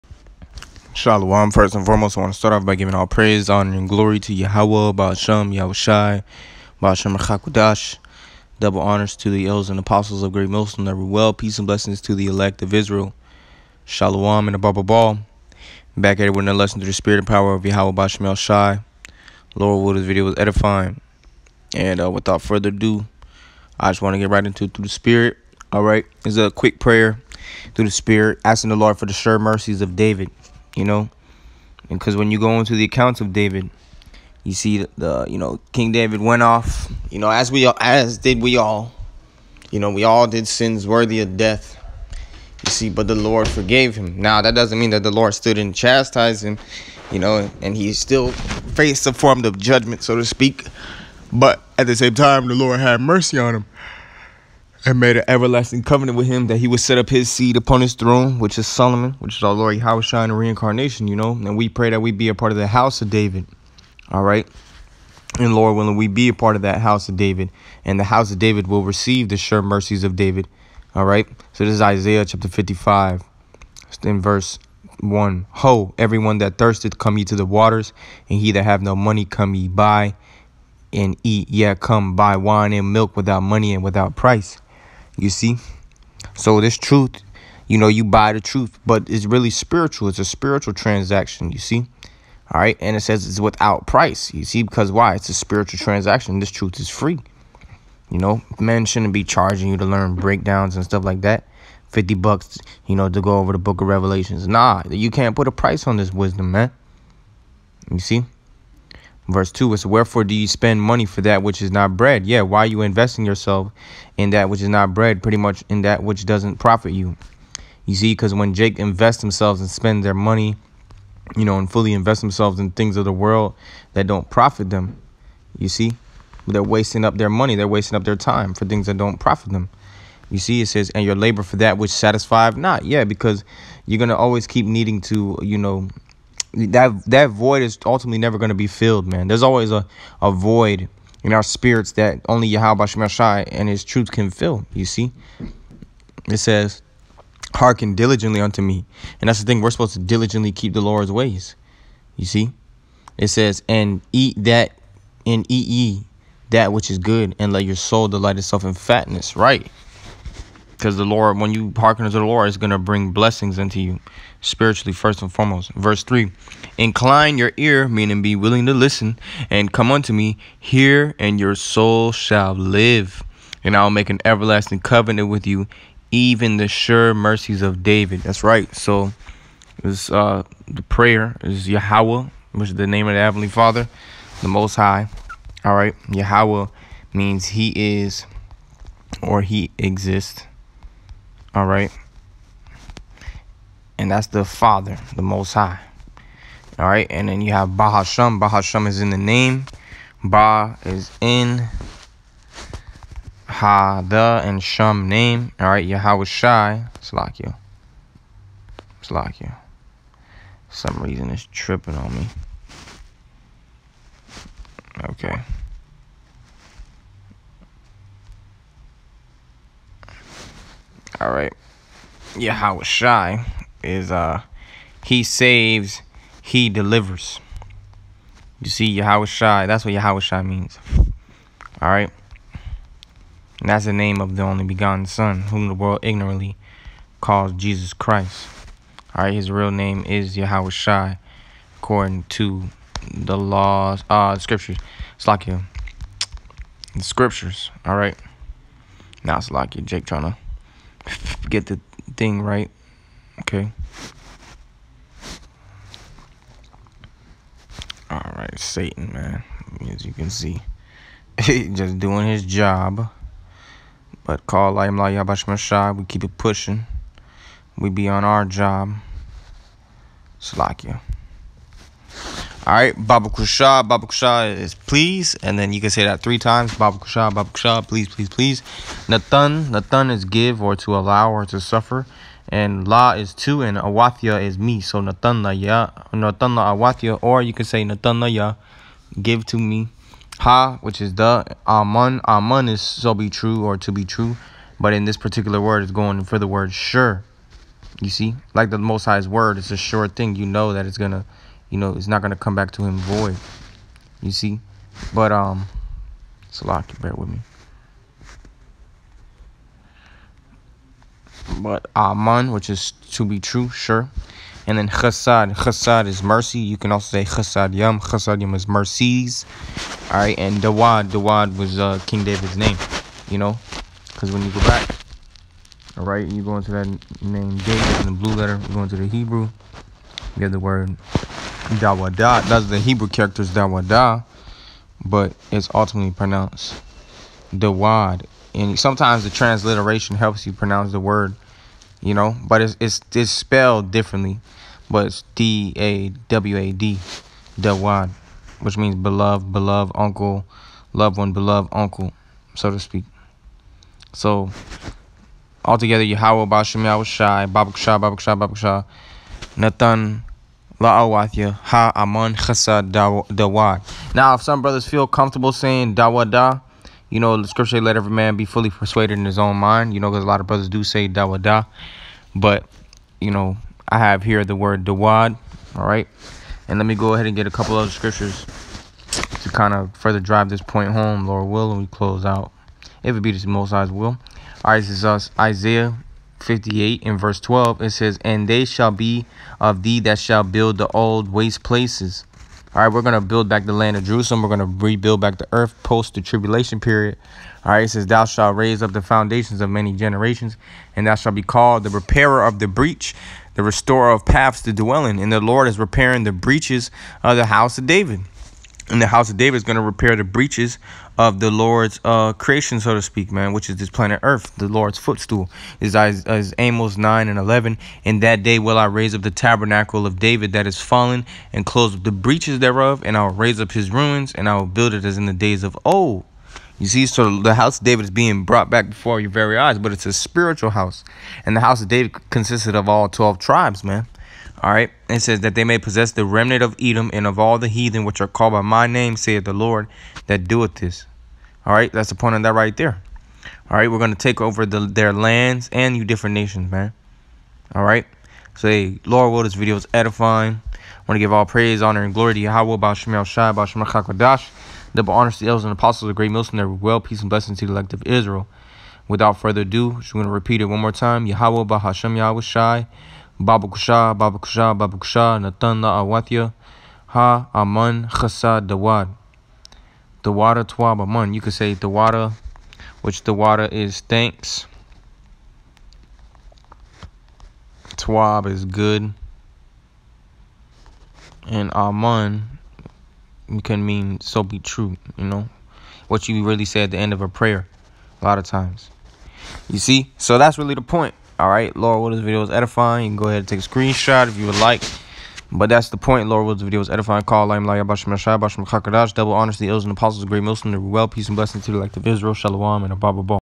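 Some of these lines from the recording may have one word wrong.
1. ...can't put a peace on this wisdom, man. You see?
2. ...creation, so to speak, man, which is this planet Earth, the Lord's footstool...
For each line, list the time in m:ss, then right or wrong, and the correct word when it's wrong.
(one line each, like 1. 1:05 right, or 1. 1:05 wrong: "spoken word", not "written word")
1. 1:45 wrong: "price", not "peace"
2. 6:52 right.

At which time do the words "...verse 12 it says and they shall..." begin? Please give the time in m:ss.
6:27.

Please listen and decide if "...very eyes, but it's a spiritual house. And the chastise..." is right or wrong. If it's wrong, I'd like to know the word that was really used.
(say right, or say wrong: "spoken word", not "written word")
wrong: "house", not "chastise".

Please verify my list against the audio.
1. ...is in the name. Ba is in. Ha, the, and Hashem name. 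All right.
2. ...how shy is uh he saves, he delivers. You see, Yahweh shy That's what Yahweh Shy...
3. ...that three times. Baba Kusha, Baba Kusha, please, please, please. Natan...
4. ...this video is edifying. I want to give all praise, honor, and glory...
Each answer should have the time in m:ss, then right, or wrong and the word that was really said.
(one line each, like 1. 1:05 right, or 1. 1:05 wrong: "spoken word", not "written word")
1. 3:18 wrong: "Shum", not "Hashem"
2. 3:42 right
3. 4:36 right
4. 7:29 right.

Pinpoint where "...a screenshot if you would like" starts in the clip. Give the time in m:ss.
8:13.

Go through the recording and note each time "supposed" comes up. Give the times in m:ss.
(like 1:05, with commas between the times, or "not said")
2:29.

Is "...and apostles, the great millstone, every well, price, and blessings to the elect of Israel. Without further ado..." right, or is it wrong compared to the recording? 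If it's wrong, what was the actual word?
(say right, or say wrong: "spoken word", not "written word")
wrong: "peace", not "price".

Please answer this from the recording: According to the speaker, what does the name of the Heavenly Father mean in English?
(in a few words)
He is or He exists.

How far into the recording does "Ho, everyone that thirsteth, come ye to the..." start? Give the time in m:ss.
1:15.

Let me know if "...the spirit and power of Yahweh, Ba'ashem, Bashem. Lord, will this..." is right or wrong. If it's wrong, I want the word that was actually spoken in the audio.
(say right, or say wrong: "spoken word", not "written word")
wrong: "Yahushai", not "Bashem".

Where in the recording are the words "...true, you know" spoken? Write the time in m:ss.
8:04.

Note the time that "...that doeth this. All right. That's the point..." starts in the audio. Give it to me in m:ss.
7:20.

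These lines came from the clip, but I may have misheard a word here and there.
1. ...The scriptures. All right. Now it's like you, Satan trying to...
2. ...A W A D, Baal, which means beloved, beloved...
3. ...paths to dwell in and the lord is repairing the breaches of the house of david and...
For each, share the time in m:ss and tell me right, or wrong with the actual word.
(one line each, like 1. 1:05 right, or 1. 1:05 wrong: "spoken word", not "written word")
1. 4:06 wrong: "Jake", not "Satan"
2. 5:45 wrong: "Dawad", not "Baal"
3. 6:44 right.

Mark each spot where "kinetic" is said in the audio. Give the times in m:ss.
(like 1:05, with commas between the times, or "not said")
not said.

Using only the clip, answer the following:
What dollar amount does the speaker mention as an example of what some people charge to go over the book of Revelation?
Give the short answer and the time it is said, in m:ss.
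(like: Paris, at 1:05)
50 bucks, at 1:41.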